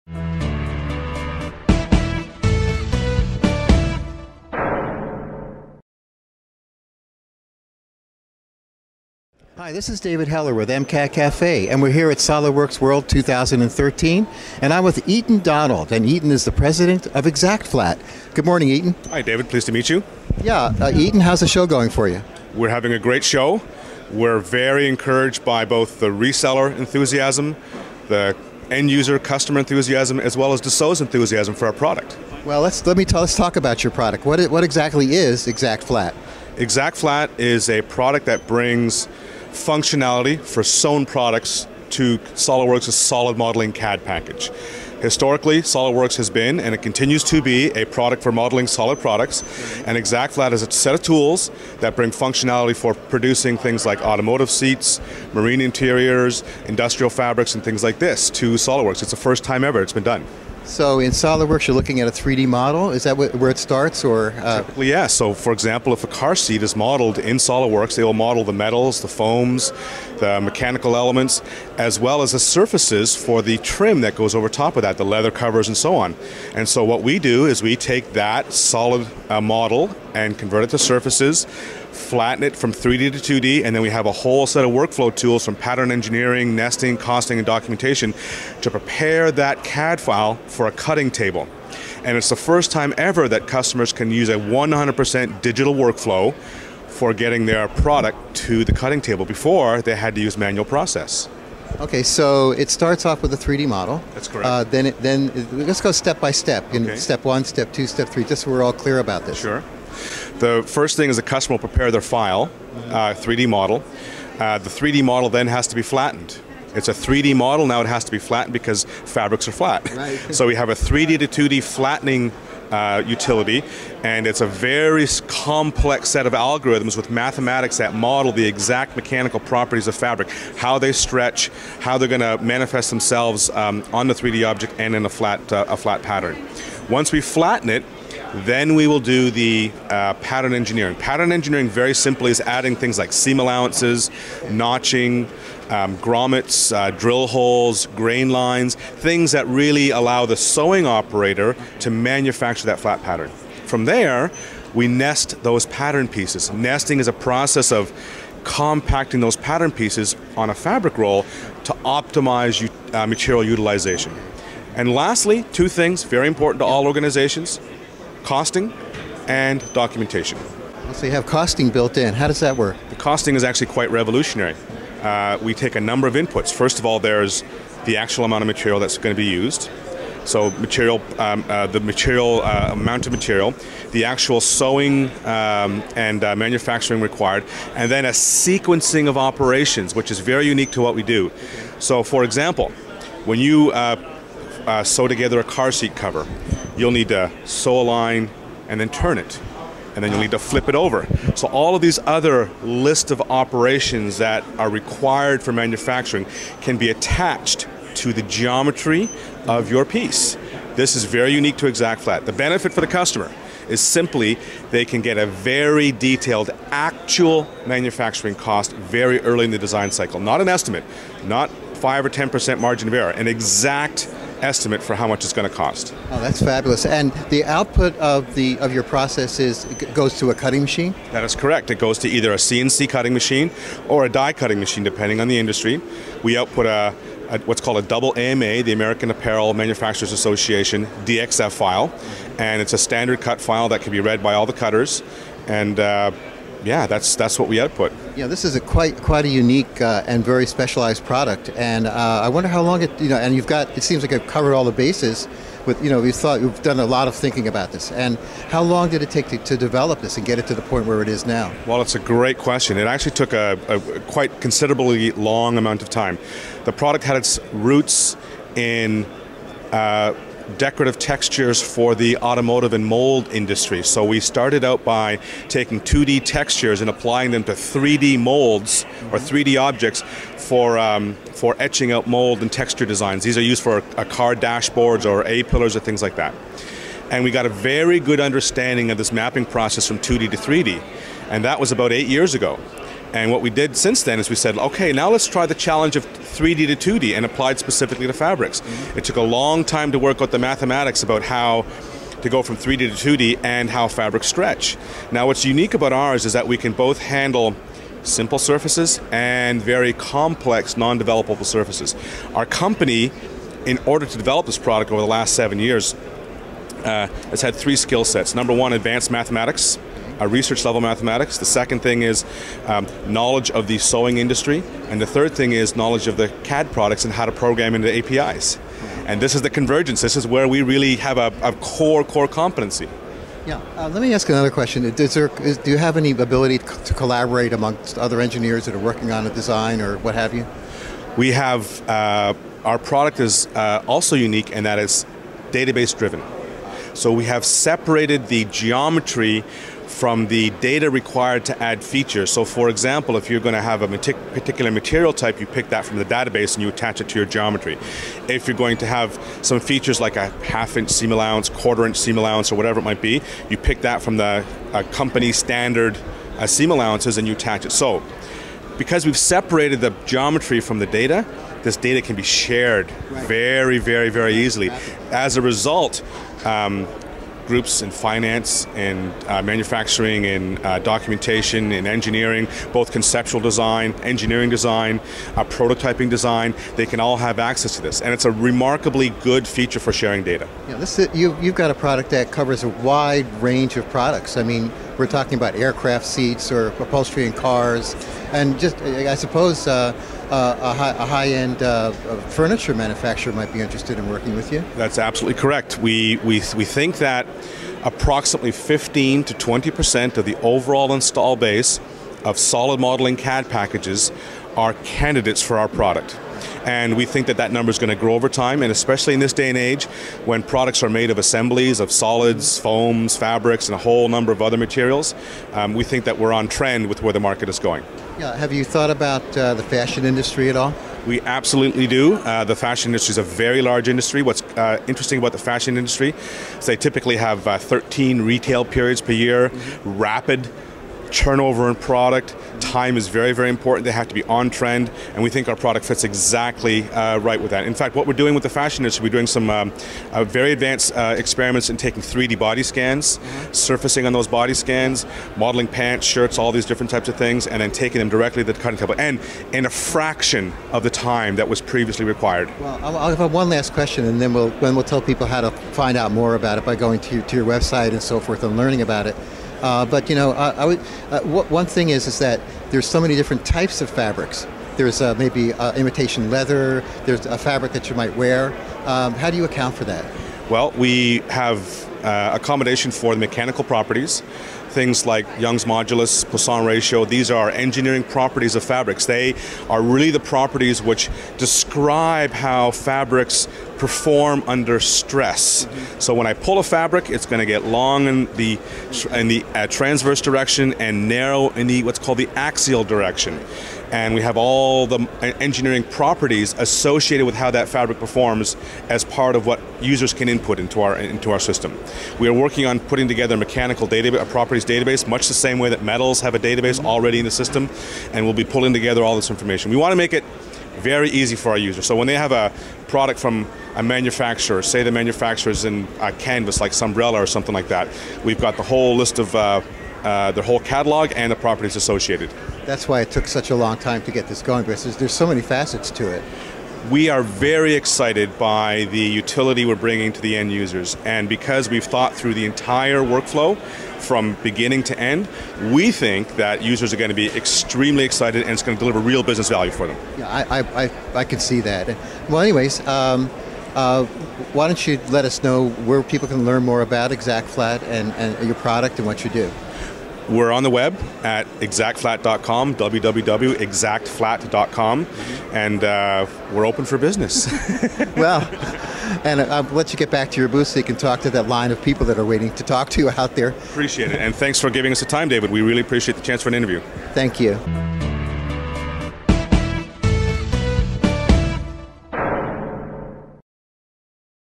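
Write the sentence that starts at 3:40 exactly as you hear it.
Not an estimate, not 5 or 10% margin of error, an exact estimate for how much it's going to cost.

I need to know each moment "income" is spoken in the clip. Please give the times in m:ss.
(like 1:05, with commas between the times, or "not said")
not said.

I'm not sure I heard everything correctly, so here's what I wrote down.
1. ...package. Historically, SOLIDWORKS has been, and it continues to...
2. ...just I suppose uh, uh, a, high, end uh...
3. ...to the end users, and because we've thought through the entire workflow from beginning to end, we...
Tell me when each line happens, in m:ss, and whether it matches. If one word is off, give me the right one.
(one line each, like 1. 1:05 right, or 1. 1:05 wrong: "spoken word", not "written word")
1. 0:44 right
2. 6:38 right
3. 9:00 right.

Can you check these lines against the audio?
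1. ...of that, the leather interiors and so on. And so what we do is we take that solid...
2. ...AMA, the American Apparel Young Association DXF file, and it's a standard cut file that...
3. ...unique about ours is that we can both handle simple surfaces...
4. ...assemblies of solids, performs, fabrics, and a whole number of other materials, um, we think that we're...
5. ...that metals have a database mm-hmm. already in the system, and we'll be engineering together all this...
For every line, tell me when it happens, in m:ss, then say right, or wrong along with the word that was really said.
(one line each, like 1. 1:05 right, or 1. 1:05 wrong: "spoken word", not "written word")
1. 1:14 wrong: "covers", not "interiors"
2. 3:58 wrong: "Manufacturers", not "Young"
3. 5:05 right
4. 7:01 wrong: "foams", not "performs"
5. 8:35 wrong: "pulling", not "engineering".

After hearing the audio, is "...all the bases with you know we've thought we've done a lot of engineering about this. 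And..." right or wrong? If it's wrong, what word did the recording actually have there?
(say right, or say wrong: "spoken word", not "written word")
wrong: "thinking", not "engineering".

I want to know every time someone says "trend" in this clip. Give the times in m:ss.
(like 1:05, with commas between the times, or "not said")
7:06, 7:24.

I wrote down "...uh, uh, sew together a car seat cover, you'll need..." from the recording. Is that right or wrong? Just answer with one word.
right.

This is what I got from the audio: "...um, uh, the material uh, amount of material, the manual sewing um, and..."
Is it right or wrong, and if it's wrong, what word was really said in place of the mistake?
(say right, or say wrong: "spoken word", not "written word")
wrong: "actual", not "manual".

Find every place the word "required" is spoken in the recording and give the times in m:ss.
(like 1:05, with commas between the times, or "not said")
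3:07, 3:24, 5:50, 7:42.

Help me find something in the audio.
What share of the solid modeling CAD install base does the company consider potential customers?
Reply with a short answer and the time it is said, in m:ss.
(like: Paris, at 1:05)
15 to 20 percent, at 6:48.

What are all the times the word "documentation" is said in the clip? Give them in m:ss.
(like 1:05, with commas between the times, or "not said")
1:27, 2:49, 6:20.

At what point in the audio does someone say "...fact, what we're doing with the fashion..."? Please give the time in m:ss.
7:27.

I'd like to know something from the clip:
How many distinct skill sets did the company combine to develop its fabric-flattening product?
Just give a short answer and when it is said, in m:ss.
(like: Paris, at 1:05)
3, at 5:17.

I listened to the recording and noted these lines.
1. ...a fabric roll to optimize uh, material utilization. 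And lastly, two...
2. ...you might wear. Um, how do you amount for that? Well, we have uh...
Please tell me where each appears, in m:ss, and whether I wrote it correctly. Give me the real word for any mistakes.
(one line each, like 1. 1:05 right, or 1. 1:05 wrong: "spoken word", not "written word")
1. 2:40 right
2. 7:57 wrong: "account", not "amount".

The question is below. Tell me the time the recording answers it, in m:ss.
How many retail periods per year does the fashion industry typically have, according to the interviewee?
7:17.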